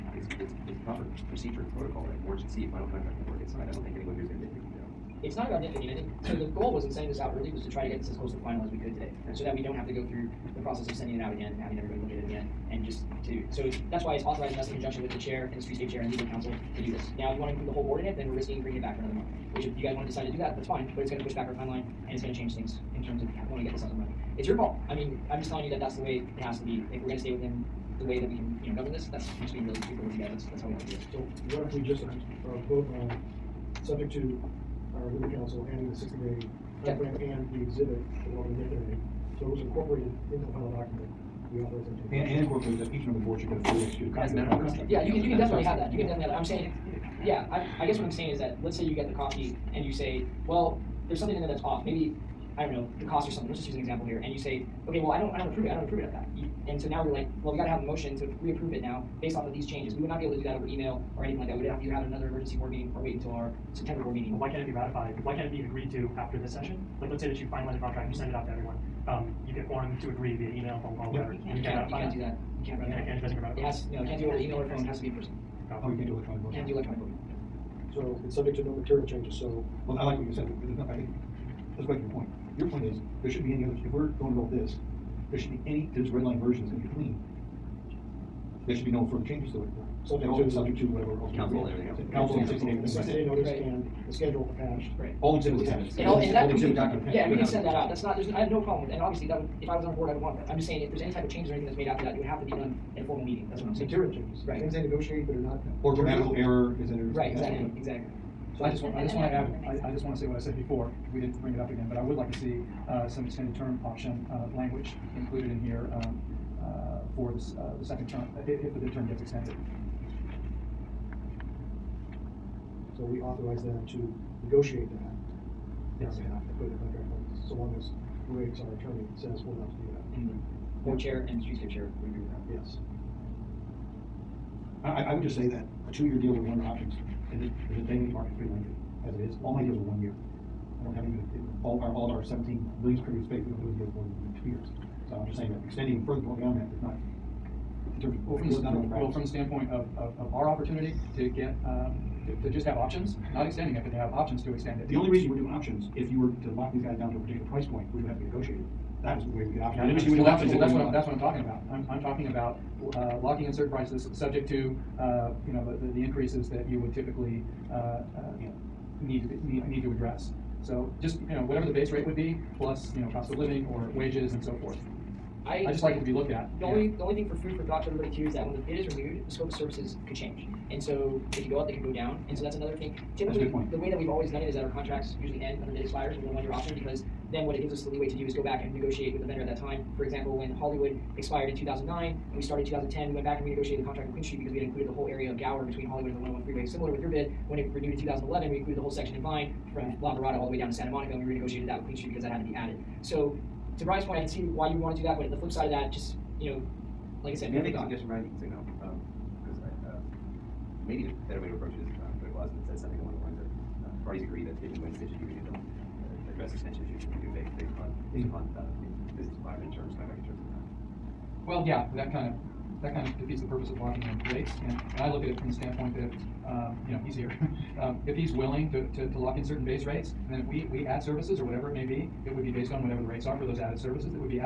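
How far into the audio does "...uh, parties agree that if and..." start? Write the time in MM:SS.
03:33.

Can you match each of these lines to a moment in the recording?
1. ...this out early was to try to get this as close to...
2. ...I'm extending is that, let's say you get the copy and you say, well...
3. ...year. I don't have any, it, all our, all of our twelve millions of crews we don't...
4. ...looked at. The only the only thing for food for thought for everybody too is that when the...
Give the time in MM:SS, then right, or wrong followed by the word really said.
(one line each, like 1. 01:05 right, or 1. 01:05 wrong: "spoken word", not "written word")
1. 00:07 right
2. 00:48 wrong: "saying", not "extending"
3. 02:20 wrong: "seventeen", not "twelve"
4. 02:56 right.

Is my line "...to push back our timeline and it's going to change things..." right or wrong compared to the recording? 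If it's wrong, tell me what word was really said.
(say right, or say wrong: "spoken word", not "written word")
right.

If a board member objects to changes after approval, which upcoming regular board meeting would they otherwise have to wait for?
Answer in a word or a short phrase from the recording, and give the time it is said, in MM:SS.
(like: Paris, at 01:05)
September, at 01:03.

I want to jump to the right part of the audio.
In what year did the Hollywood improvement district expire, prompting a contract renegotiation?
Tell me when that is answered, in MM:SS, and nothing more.
03:11.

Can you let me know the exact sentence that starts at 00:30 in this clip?
That's that's how we have to do it.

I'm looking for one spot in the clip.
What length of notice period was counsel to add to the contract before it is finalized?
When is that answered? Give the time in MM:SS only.
00:35.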